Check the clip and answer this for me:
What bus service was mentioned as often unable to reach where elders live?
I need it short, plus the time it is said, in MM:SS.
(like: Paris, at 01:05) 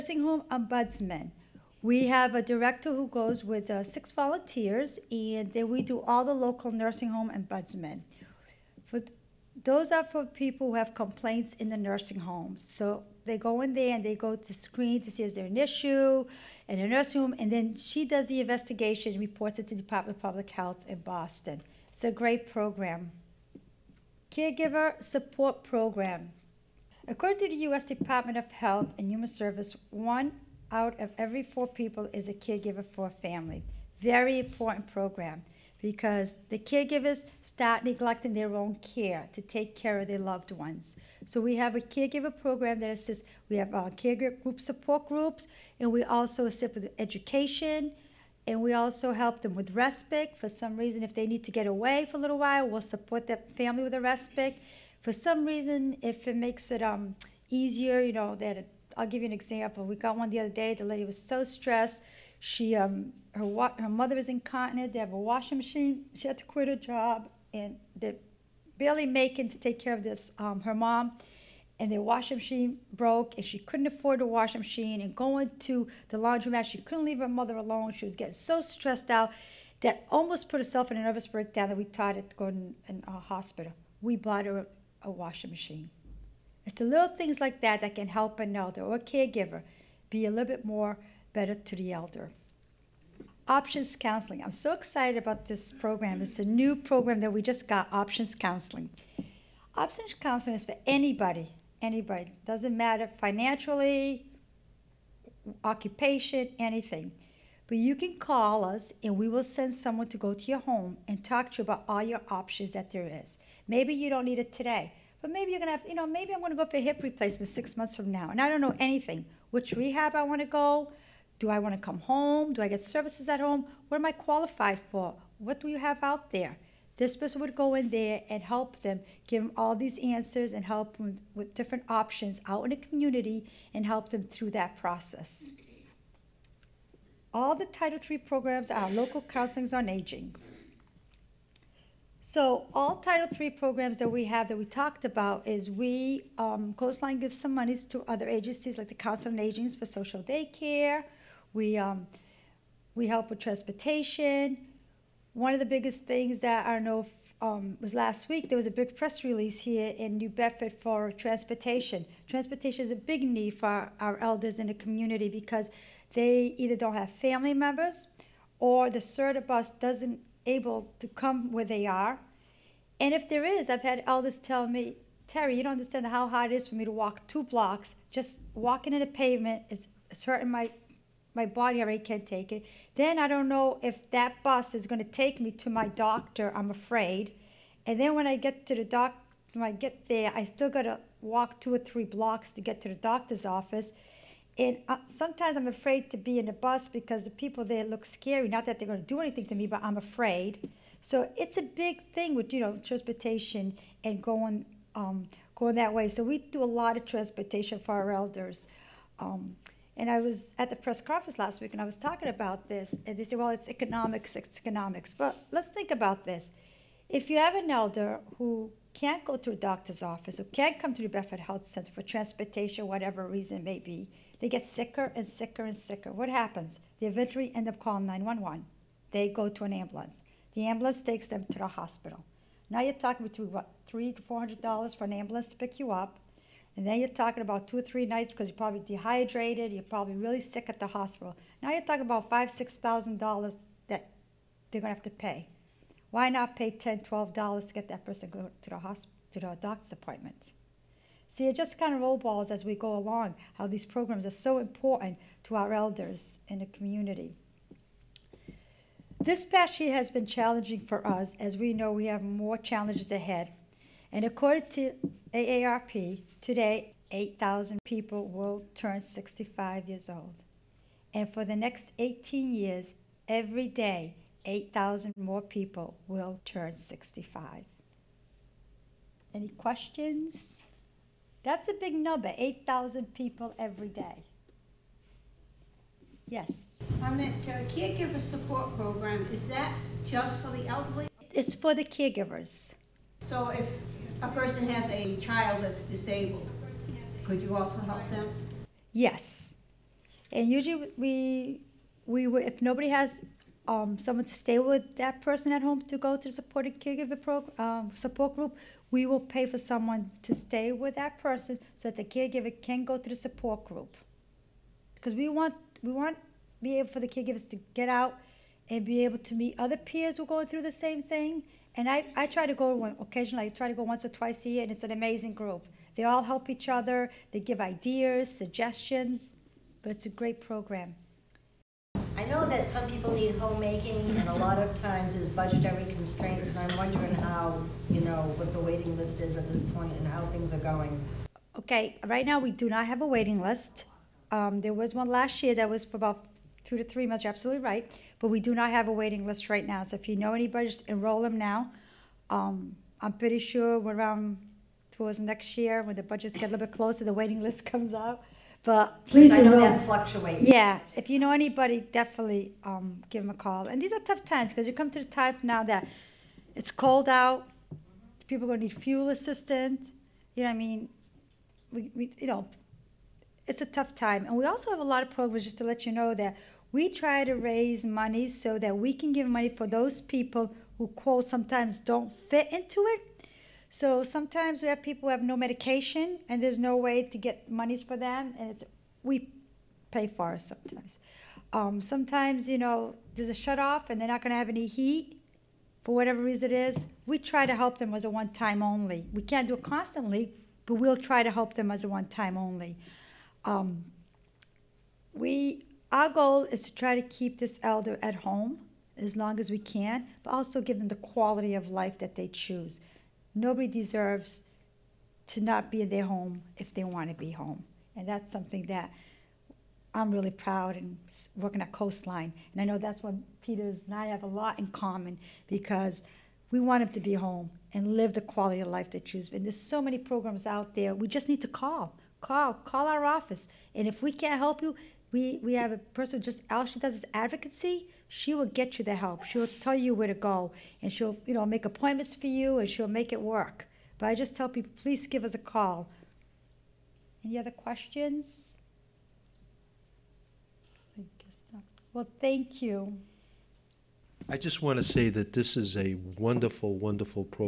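SRTA, at 02:48.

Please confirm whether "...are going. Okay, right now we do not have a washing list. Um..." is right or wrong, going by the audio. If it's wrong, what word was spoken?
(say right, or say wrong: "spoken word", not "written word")
wrong: "waiting", not "washing".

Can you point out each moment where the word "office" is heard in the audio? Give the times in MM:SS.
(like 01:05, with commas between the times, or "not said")
03:13, 03:40, 07:13.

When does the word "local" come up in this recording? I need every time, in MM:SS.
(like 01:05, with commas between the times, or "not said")
00:06, 02:18.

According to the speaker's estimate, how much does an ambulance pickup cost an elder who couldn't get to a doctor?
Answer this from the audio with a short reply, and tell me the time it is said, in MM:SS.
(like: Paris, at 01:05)
$300 to $400, at 03:53.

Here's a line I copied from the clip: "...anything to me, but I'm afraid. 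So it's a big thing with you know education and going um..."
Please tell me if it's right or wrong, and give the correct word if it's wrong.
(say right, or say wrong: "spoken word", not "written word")
wrong: "transportation", not "education".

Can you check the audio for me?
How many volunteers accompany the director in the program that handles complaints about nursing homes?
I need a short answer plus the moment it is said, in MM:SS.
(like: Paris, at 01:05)
6, at 00:03.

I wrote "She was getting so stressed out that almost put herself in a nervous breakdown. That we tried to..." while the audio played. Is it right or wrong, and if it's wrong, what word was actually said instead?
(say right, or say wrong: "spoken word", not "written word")
right.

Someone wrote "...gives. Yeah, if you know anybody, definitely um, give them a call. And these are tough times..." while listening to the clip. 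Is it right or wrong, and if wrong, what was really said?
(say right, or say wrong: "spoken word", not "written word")
wrong: "fluctuates", not "gives".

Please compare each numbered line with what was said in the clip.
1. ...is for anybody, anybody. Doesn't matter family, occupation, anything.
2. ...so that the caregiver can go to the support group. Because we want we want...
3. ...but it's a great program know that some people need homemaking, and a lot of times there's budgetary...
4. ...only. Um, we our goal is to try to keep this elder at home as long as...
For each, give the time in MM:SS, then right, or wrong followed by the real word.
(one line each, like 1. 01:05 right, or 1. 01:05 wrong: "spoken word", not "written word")
1. 01:40 wrong: "financially", not "family"
2. 05:11 right
3. 05:29 right
4. 06:42 right.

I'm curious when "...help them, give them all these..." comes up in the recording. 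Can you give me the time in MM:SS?
02:08.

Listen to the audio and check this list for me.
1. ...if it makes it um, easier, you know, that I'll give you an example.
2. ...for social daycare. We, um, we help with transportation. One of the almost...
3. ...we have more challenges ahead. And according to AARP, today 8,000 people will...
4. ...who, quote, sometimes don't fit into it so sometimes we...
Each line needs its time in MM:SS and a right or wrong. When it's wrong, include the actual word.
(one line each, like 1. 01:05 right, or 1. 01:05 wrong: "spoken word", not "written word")
1. 00:56 right
2. 02:29 wrong: "biggest", not "almost"
3. 04:21 right
4. 06:20 right.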